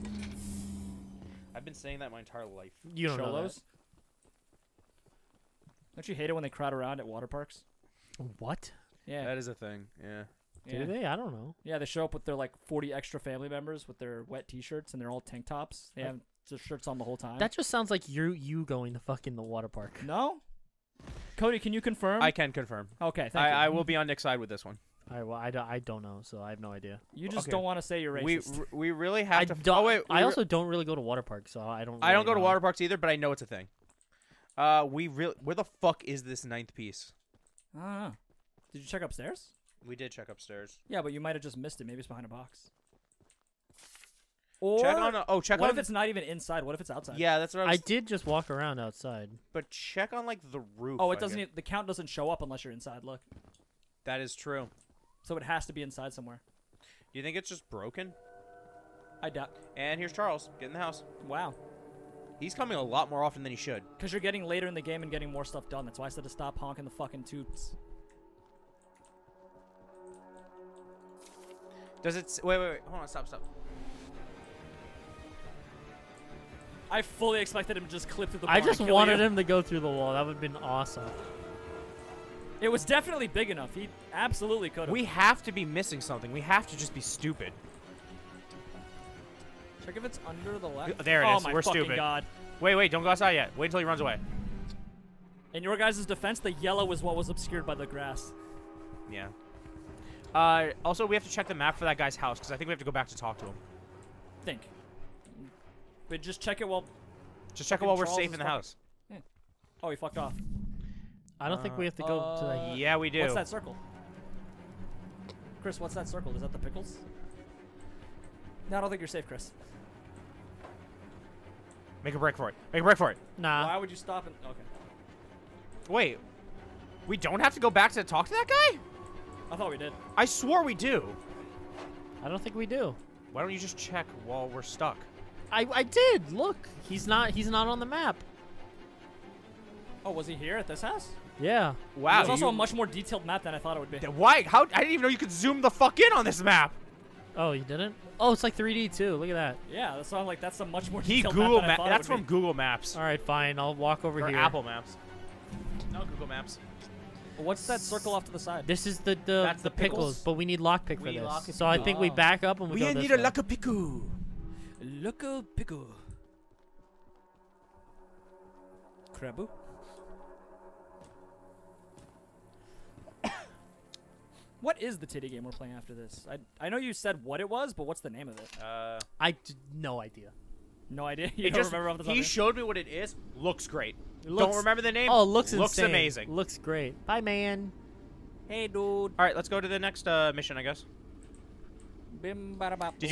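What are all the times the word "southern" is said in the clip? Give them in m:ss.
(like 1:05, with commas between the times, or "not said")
not said.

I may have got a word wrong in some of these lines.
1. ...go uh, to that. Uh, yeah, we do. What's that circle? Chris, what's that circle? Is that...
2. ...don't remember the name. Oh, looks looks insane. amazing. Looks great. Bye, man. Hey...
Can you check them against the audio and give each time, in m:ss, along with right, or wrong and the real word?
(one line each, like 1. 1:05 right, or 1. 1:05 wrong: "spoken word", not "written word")
1. 1:52 right
2. 3:04 right.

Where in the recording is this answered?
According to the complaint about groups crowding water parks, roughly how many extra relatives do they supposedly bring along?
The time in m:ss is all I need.
0:12.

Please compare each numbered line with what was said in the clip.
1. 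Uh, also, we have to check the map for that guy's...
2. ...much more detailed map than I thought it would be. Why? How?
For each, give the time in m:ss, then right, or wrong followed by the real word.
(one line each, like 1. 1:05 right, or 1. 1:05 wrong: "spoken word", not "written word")
1. 1:40 right
2. 2:22 right.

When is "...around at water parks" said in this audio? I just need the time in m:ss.
0:06.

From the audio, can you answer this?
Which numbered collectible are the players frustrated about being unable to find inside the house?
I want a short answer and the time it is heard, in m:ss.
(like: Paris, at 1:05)
ninth, at 0:36.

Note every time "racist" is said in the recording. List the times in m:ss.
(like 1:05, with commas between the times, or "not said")
0:28.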